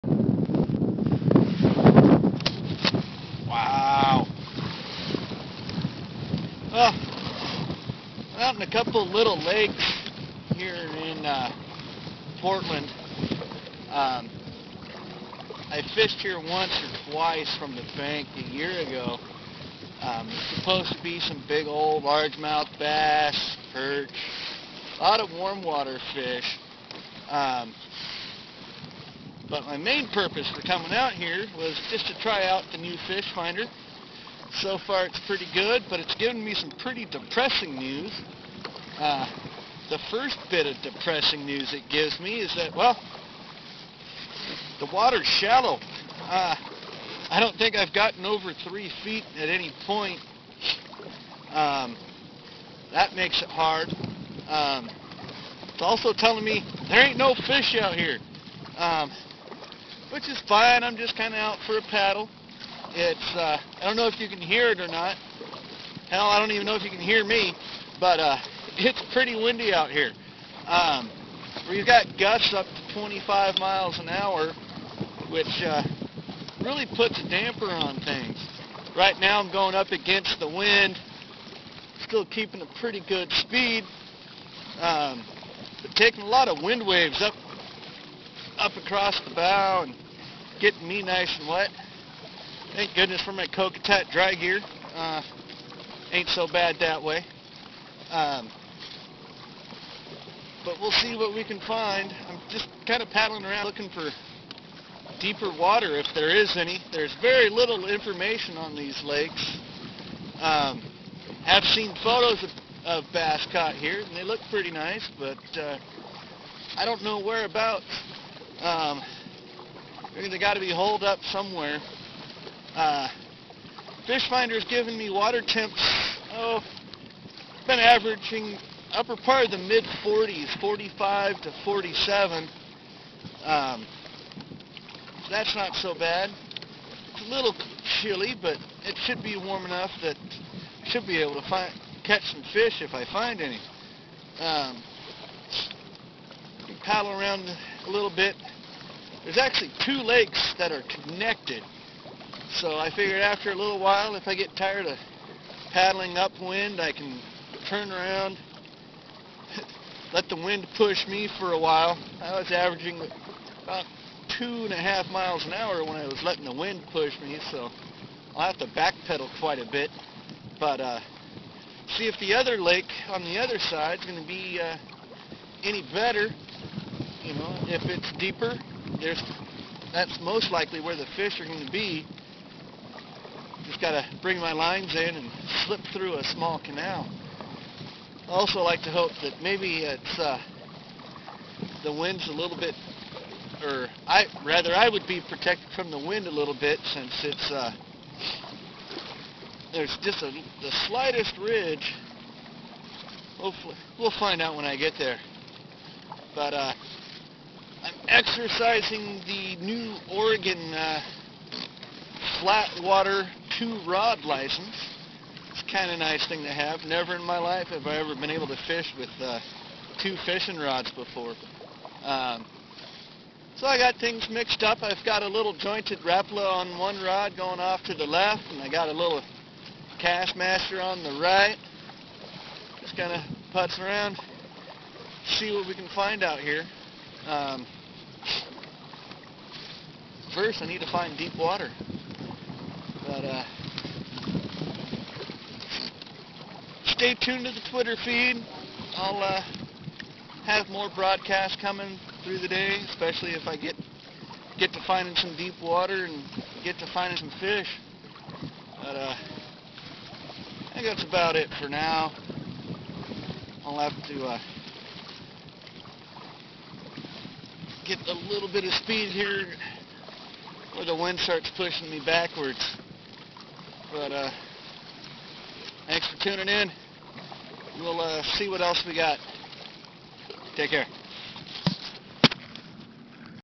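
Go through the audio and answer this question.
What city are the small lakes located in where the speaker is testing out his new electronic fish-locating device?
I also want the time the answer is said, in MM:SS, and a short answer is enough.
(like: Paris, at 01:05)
Portland, at 00:12.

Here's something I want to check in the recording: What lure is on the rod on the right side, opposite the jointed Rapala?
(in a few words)
Kastmaster.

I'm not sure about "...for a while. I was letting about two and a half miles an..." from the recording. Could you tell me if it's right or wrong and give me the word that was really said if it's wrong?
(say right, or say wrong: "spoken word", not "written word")
wrong: "averaging", not "letting".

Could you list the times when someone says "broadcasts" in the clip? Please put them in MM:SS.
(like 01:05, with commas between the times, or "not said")
04:10.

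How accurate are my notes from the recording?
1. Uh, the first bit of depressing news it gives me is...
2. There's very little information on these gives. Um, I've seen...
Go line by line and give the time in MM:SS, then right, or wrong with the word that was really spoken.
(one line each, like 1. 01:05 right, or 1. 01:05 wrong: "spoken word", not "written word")
1. 00:38 right
2. 01:46 wrong: "lakes", not "gives".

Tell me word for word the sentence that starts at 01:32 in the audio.
Thank goodness for my Kokatat dry gear.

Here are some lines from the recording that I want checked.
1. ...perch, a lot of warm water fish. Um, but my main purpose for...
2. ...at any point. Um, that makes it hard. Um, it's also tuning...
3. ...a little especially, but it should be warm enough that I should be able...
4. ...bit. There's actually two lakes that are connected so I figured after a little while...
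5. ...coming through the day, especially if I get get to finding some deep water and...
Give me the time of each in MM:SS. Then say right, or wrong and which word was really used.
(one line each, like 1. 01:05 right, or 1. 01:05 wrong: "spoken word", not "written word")
1. 00:23 right
2. 00:49 wrong: "telling", not "tuning"
3. 02:17 wrong: "chilly", not "especially"
4. 02:28 right
5. 04:11 right.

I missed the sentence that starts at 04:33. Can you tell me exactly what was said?
But uh, thanks for tuning in.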